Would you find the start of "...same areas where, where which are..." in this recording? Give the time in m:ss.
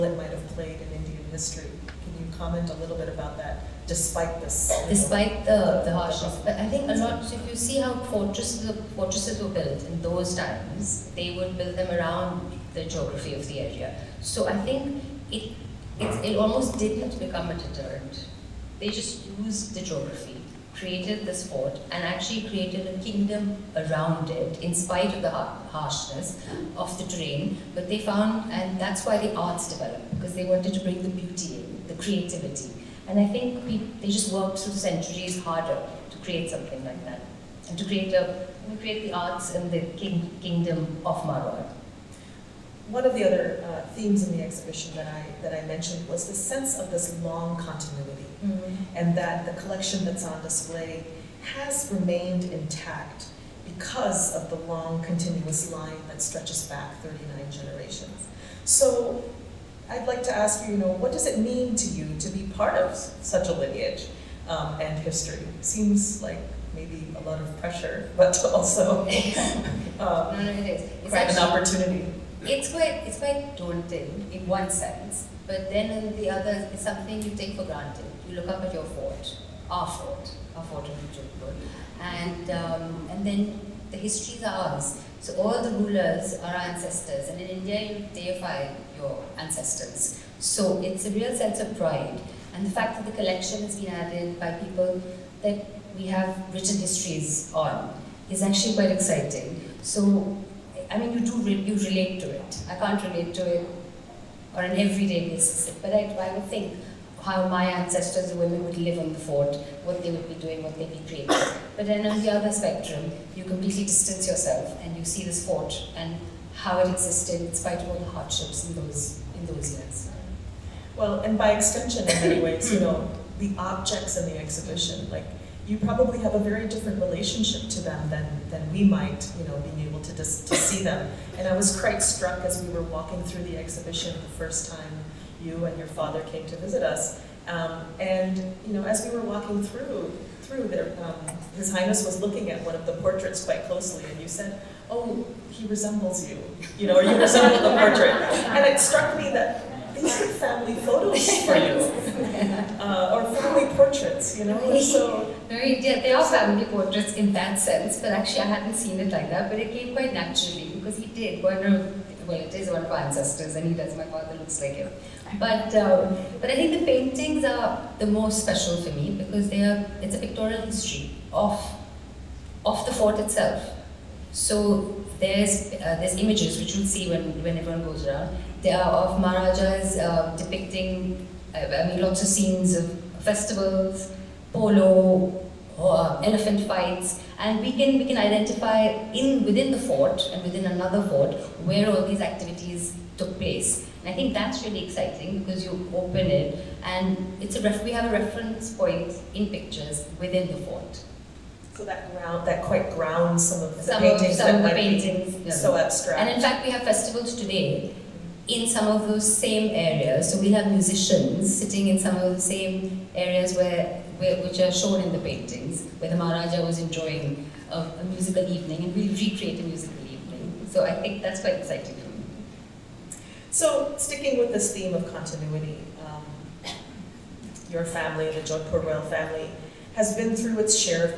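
3:32.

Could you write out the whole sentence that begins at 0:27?
But they found, and that's why the arts developed, because they wanted to bring the beauty in, the creativity.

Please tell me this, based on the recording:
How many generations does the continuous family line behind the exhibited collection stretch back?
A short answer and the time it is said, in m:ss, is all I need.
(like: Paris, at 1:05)
39, at 0:57.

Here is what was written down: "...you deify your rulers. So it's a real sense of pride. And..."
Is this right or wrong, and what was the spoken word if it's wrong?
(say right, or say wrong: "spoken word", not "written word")
wrong: "ancestors", not "rulers".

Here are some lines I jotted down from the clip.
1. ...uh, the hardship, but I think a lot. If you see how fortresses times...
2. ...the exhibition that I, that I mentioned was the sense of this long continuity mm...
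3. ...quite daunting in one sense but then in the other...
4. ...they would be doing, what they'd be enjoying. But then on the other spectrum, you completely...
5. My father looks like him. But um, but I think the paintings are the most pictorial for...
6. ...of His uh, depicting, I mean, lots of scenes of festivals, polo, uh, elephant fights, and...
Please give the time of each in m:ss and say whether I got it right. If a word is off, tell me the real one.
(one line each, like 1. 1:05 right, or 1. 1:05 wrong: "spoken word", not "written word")
1. 0:05 wrong: "fortresses", not "times"
2. 0:44 right
3. 1:13 right
4. 1:50 wrong: "creating", not "enjoying"
5. 2:43 wrong: "special", not "pictorial"
6. 2:58 wrong: "Maharajas", not "His".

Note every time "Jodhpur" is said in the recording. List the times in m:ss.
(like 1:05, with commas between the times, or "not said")
1:21, 3:48.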